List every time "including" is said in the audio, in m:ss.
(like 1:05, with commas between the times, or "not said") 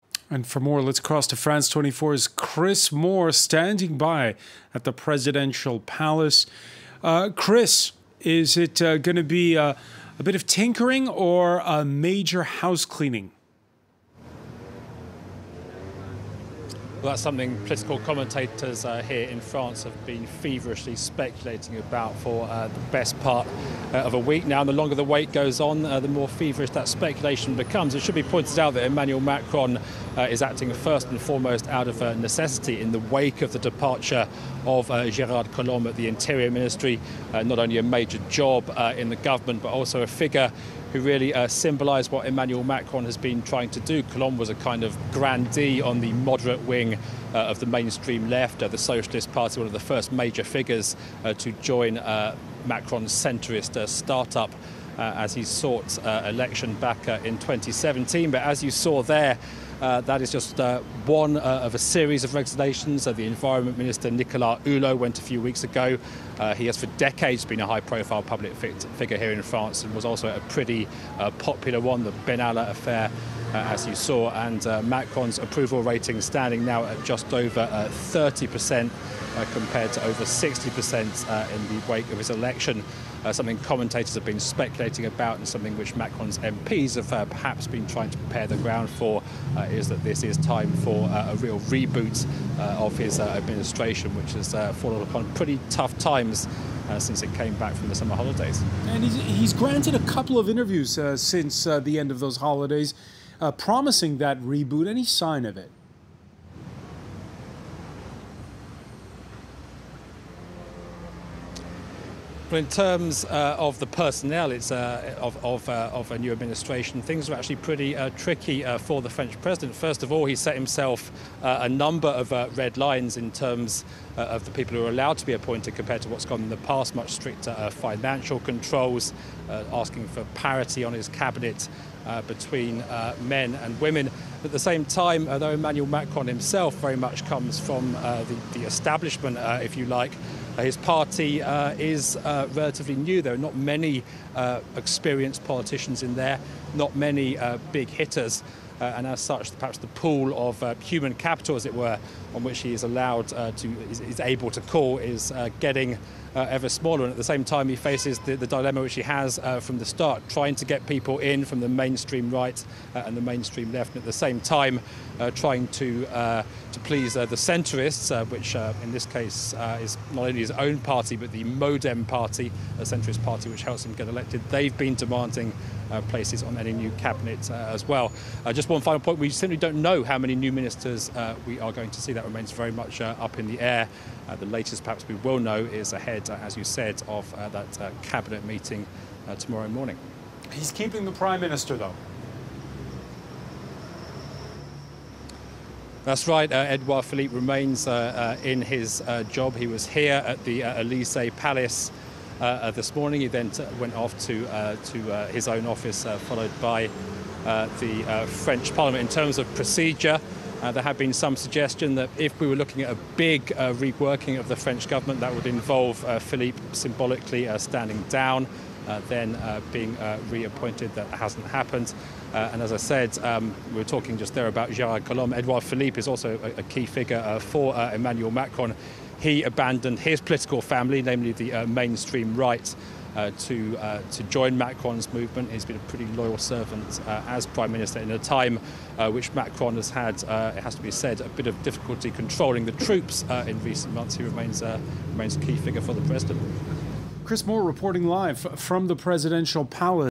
not said.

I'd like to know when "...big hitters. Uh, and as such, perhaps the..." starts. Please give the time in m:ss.
2:27.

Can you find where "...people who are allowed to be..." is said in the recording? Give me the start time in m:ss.
2:04.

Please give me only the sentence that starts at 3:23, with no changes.
He then went off to to his own office, followed by the French Parliament.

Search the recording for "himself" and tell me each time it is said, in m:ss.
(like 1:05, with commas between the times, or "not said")
2:00, 2:16.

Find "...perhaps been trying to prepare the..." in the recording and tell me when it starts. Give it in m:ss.
1:27.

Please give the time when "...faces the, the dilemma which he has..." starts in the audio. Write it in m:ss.
2:37.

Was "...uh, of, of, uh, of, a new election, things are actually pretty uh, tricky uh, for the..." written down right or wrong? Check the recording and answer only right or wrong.
wrong.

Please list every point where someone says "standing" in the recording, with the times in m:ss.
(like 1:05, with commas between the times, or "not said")
0:03, 1:16, 3:37.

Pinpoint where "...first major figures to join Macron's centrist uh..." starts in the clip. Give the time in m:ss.
0:49.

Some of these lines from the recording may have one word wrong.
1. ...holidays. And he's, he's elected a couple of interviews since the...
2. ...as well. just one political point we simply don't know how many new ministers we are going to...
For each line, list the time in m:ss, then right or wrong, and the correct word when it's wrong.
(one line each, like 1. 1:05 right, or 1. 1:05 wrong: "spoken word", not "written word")
1. 1:38 wrong: "granted", not "elected"
2. 2:57 wrong: "final", not "political".